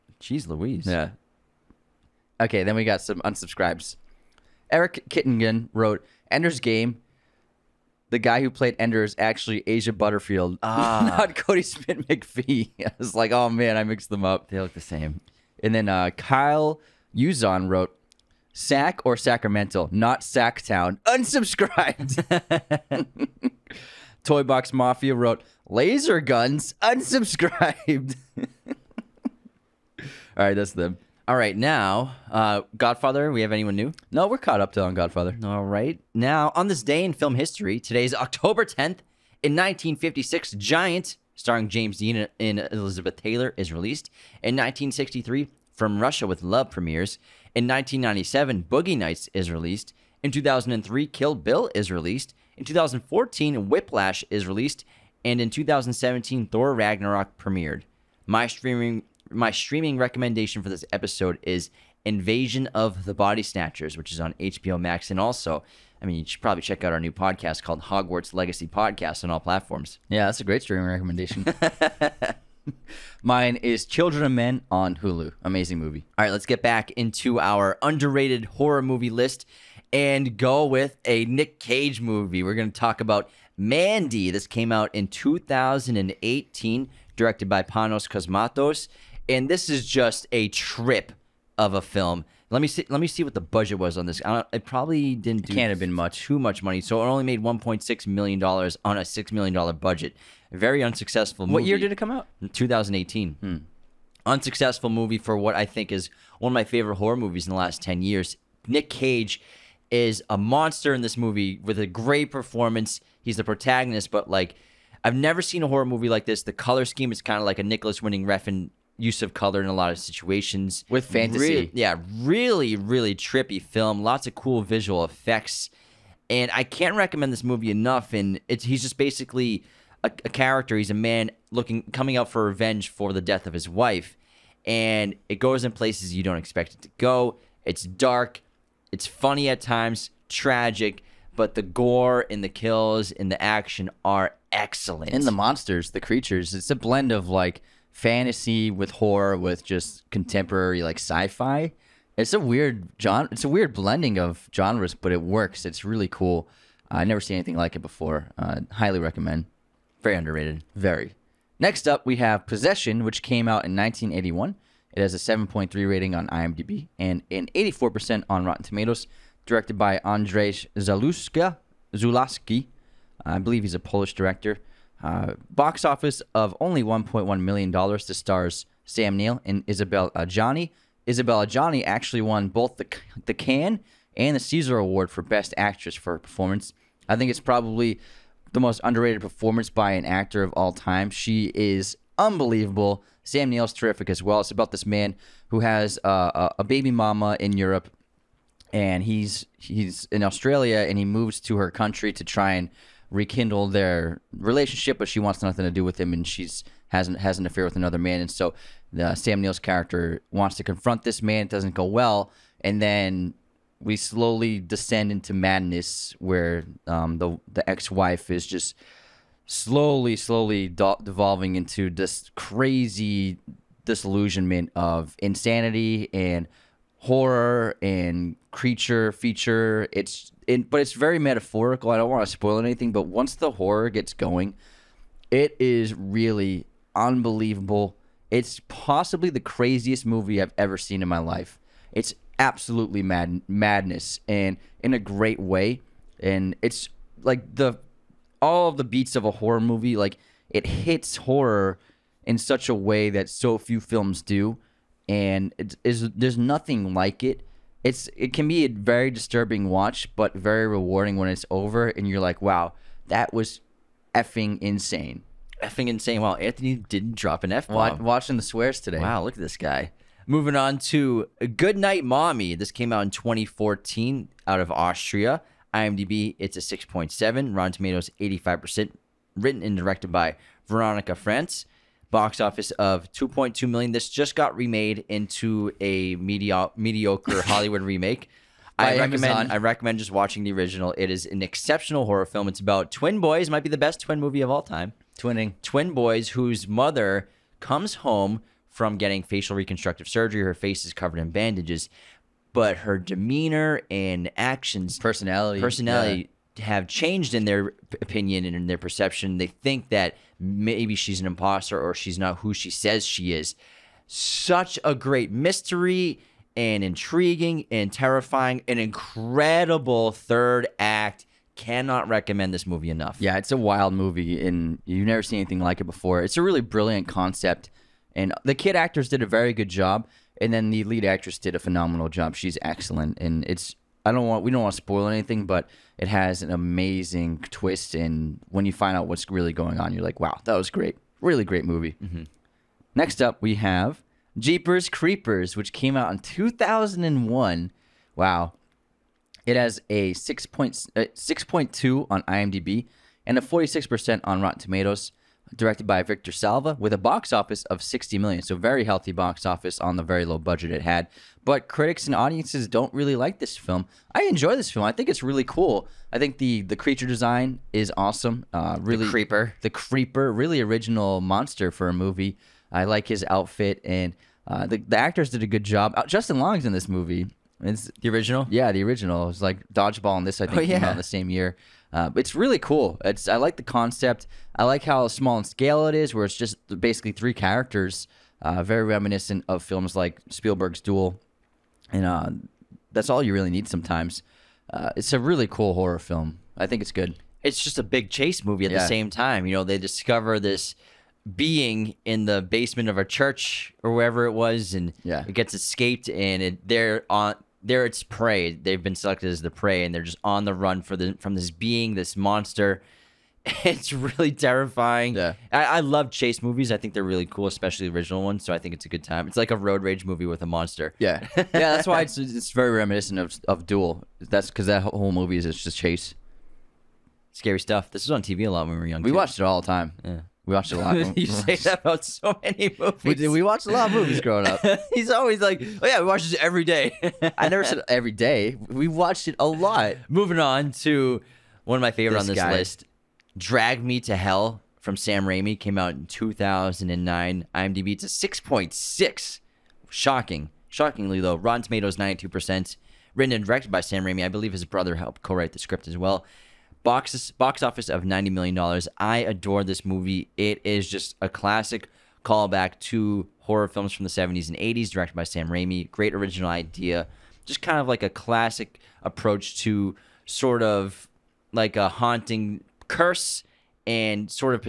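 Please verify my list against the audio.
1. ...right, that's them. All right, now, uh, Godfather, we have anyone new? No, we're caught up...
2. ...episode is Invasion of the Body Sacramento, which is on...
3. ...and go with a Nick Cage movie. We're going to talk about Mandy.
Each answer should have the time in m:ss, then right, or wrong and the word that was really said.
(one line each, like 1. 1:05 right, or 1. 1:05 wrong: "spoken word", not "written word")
1. 0:30 right
2. 1:00 wrong: "Snatchers", not "Sacramento"
3. 1:19 right.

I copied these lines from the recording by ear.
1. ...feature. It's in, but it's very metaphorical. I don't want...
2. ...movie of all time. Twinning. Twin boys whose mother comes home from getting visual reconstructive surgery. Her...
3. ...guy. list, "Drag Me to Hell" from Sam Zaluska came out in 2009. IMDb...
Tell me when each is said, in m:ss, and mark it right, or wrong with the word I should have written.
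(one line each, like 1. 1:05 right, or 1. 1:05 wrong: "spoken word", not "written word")
1. 3:49 right
2. 4:54 wrong: "facial", not "visual"
3. 7:22 wrong: "Raimi", not "Zaluska".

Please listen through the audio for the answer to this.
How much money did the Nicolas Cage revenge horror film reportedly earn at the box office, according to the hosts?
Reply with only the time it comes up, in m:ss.
1:37.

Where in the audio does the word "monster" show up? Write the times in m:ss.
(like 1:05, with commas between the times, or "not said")
1:50, 2:25, 6:11, 6:52, 7:00.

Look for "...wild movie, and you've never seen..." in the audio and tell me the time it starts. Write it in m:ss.
5:23.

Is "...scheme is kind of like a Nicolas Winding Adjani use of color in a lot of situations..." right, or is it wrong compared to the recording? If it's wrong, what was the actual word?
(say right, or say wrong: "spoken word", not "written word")
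wrong: "Refn", not "Adjani".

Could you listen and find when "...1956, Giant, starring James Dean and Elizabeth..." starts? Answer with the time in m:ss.
0:39.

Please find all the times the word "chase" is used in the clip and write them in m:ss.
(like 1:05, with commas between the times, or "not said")
6:38, 6:56, 7:05.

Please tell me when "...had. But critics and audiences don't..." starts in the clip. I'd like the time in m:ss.
6:00.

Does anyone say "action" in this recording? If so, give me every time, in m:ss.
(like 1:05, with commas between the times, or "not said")
2:23, 5:04.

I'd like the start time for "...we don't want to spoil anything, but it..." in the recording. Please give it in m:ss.
5:34.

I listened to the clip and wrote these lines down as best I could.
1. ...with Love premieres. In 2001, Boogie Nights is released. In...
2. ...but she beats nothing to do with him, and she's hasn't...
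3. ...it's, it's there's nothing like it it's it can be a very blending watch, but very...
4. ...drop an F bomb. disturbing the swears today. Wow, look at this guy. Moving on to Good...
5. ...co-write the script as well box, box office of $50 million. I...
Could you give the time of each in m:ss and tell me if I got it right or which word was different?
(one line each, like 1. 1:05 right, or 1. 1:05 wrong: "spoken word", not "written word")
1. 0:46 wrong: "1997", not "2001"
2. 3:24 wrong: "wants", not "beats"
3. 4:15 wrong: "disturbing", not "blending"
4. 4:27 wrong: "watching", not "disturbing"
5. 7:35 wrong: "90", not "50".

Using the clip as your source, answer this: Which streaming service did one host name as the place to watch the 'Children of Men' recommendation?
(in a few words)
Hulu.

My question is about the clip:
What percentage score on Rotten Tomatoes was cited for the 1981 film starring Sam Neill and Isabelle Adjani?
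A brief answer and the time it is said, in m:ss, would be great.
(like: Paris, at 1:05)
84%, at 2:47.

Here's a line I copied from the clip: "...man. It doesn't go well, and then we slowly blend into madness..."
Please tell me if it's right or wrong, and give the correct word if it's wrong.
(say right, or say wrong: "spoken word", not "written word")
wrong: "descend", not "blend".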